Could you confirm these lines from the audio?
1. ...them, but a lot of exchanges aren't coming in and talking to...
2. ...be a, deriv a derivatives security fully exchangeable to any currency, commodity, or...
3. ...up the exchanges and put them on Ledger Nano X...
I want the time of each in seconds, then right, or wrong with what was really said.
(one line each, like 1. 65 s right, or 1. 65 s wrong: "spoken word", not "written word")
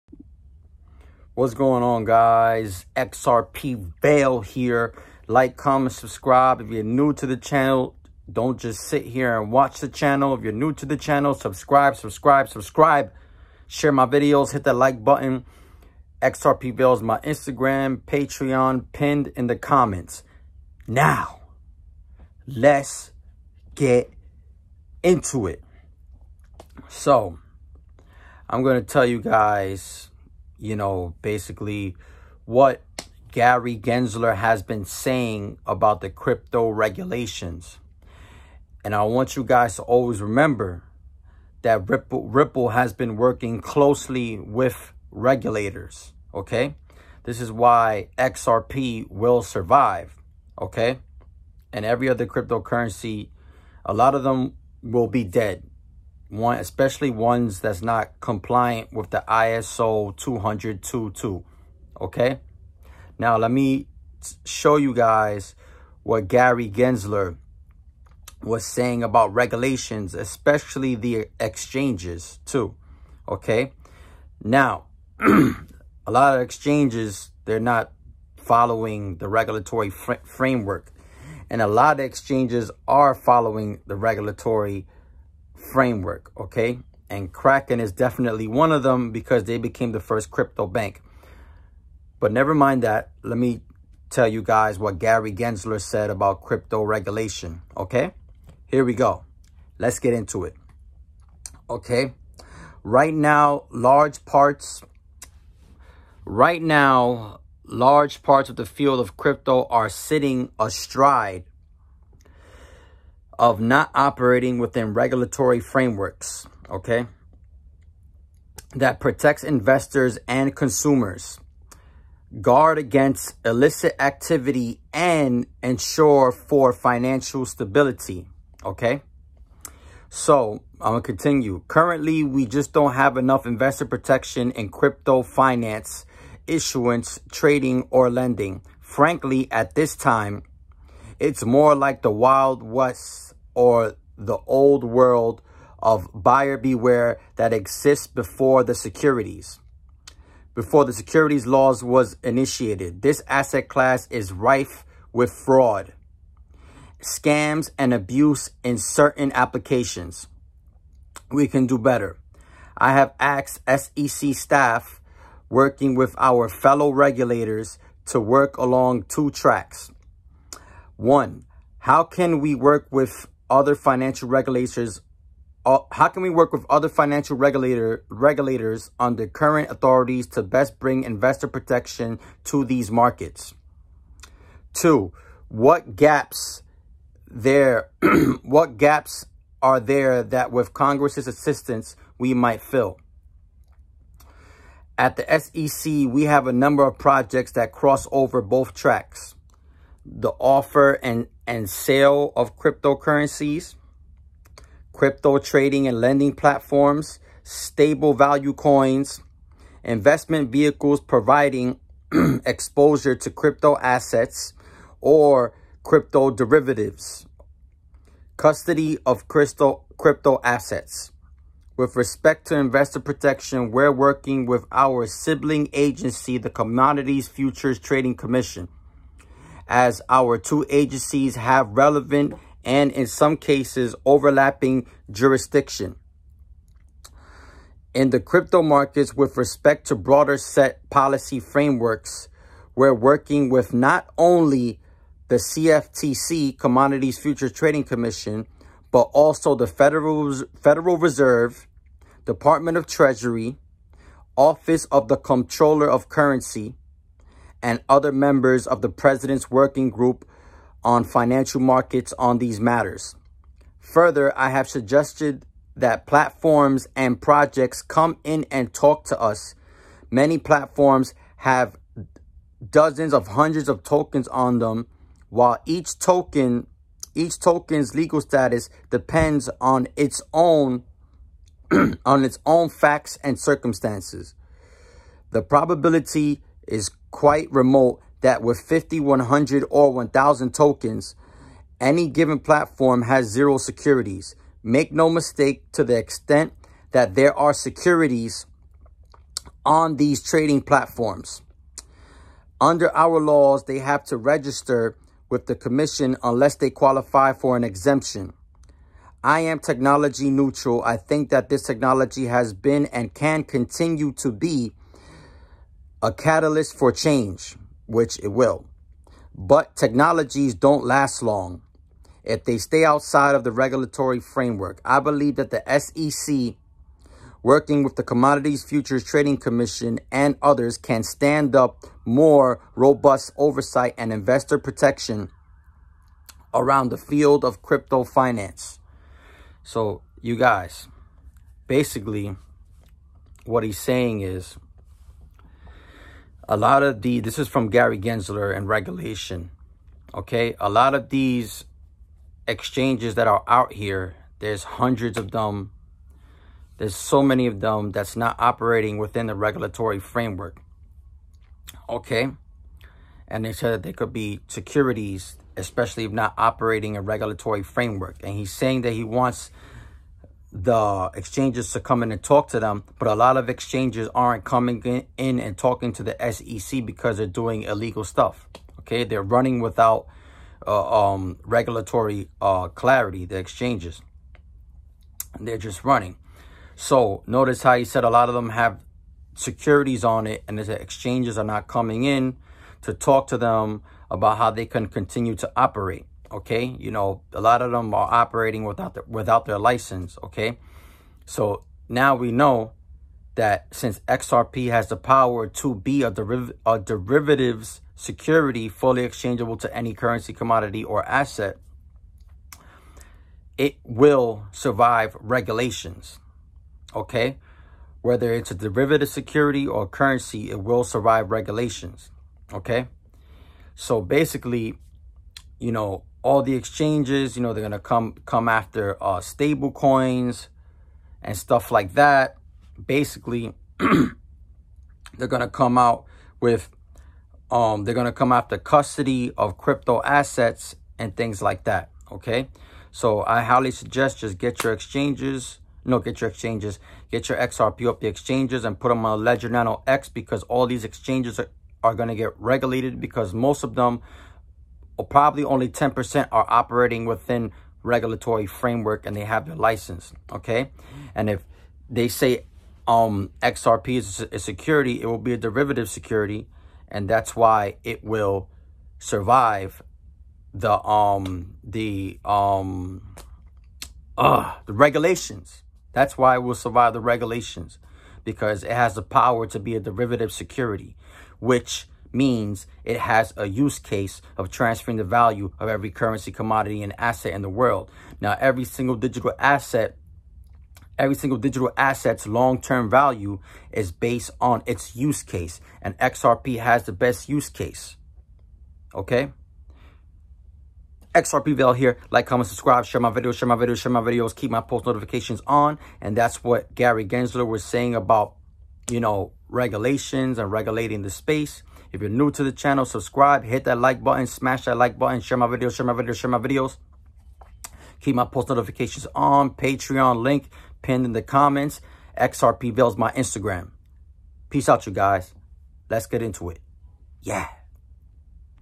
1. 372 s right
2. 405 s right
3. 447 s right.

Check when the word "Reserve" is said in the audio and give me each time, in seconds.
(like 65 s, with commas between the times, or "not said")
250 s.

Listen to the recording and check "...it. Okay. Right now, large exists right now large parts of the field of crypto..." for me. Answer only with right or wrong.
wrong.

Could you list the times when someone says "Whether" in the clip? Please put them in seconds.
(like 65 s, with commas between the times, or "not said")
418 s.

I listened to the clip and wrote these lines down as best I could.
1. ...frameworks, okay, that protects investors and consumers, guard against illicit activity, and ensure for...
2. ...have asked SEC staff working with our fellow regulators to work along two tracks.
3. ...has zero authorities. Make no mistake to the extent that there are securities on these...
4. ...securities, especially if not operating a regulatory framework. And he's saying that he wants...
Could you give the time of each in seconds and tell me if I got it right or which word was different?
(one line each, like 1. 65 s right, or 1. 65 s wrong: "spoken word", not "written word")
1. 115 s right
2. 162 s right
3. 293 s wrong: "securities", not "authorities"
4. 364 s right.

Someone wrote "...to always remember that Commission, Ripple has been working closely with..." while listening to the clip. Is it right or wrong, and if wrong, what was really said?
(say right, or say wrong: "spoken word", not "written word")
wrong: "Ripple", not "Commission".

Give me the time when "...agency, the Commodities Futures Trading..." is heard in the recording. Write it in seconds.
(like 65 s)
225 s.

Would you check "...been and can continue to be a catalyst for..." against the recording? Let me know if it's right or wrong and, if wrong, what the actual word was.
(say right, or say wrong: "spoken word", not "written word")
right.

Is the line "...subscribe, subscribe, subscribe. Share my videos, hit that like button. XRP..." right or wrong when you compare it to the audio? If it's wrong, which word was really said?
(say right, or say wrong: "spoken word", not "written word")
right.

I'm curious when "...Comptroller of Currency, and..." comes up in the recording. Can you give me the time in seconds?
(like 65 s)
255 s.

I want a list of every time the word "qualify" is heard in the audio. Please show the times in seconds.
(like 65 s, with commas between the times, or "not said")
306 s.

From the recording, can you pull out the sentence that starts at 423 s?
So basically, you know, all the exchanges, you know, they're going to come come after uh, stable coins and stuff like that.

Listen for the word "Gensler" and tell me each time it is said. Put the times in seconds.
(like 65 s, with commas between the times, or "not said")
33 s, 66 s, 95 s, 347 s, 507 s.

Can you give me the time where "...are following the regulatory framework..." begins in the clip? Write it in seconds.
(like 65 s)
82 s.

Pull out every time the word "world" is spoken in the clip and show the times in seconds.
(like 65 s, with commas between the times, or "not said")
144 s, 487 s.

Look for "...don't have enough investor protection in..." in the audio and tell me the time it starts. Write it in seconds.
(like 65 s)
132 s.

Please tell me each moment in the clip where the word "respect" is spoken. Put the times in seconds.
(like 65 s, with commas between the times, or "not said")
221 s, 239 s.